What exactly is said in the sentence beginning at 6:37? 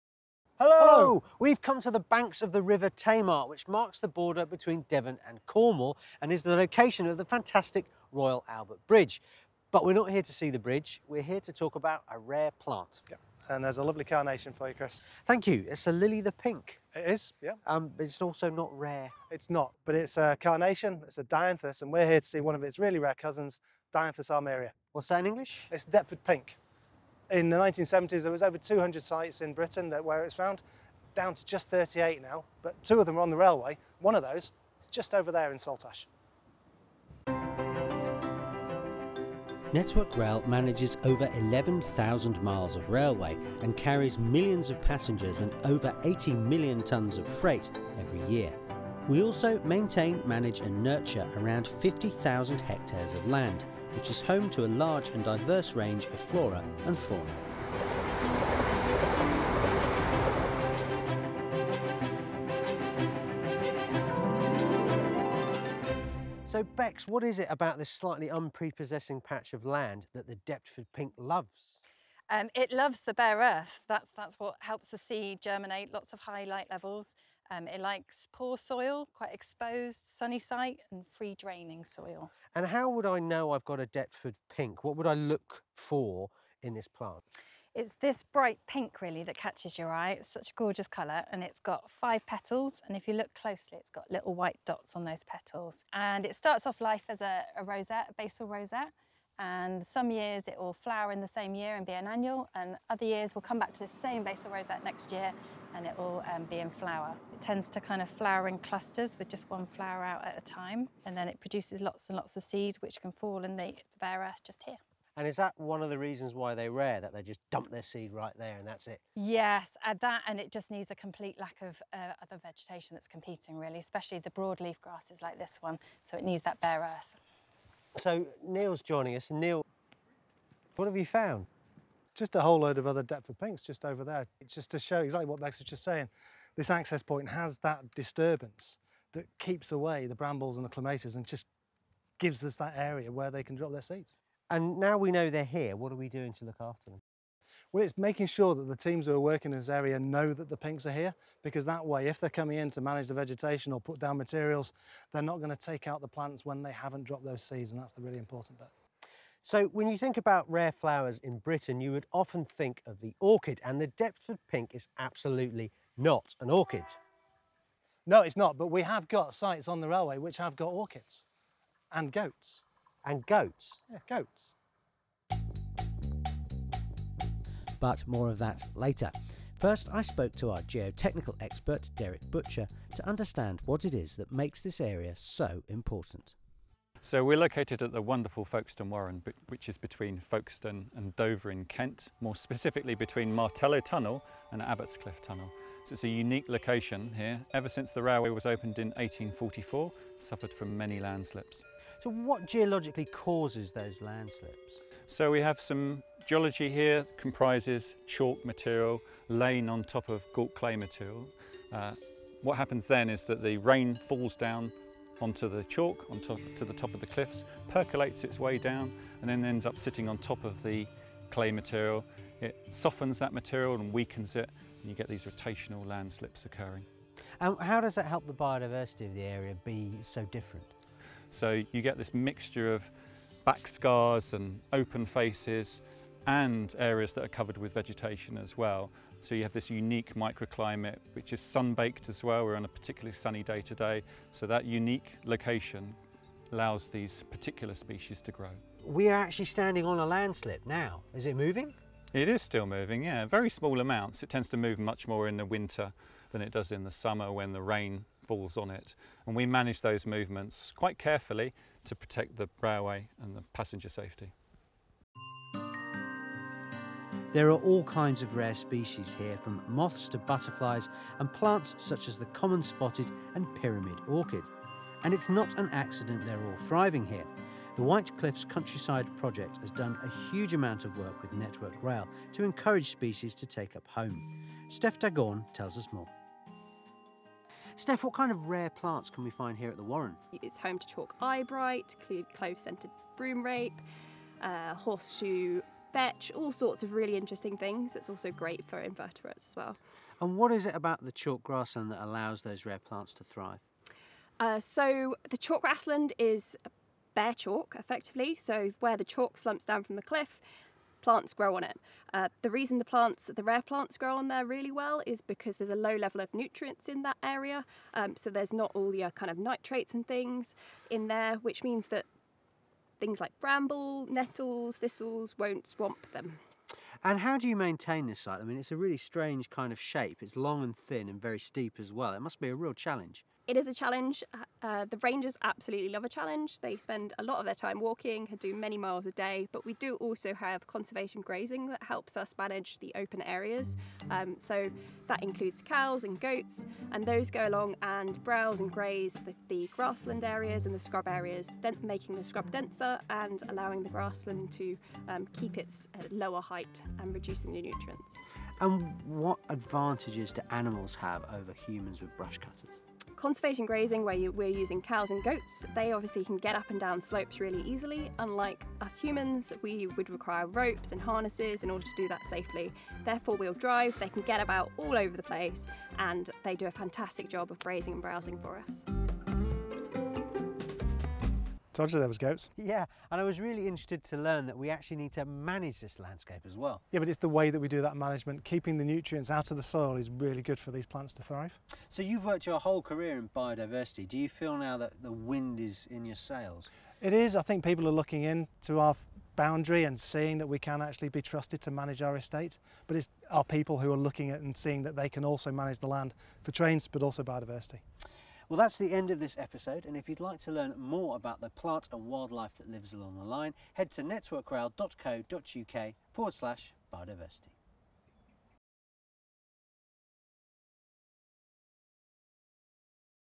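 I think people are looking in to our boundary and seeing that we can actually be trusted to manage our estate.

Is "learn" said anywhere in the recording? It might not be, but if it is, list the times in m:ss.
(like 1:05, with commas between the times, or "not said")
6:24, 6:50.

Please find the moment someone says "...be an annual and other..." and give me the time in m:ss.
1:41.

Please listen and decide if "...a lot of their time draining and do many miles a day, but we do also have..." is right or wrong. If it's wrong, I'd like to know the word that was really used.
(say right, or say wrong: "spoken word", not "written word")
wrong: "walking", not "draining".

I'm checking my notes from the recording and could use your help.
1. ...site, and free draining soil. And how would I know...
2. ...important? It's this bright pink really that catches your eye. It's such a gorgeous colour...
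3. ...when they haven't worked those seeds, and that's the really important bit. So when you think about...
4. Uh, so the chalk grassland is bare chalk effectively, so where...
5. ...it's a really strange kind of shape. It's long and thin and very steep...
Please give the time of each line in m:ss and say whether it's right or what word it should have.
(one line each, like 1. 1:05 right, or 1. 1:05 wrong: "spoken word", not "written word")
1. 1:20 right
2. 1:26 wrong: "plant", not "important"
3. 2:36 wrong: "dropped", not "worked"
4. 5:04 right
5. 5:28 right.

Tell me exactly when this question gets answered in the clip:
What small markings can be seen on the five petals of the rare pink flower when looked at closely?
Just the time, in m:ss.
1:34.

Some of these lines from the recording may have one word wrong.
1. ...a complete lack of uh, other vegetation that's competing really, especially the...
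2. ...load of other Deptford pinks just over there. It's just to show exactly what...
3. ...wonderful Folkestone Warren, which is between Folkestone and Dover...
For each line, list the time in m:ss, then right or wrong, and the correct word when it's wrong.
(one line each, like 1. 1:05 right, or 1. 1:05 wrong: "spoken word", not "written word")
1. 2:00 right
2. 2:12 right
3. 3:08 right.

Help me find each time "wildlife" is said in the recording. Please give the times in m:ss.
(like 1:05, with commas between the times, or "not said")
6:52.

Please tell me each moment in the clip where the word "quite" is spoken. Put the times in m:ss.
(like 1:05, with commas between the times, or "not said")
1:19, 4:20.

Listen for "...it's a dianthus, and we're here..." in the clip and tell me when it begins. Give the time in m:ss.
0:21.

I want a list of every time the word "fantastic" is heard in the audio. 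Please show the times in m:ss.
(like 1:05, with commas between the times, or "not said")
0:07, 6:16.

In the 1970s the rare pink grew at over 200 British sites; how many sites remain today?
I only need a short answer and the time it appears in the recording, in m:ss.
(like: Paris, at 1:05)
38, at 0:31.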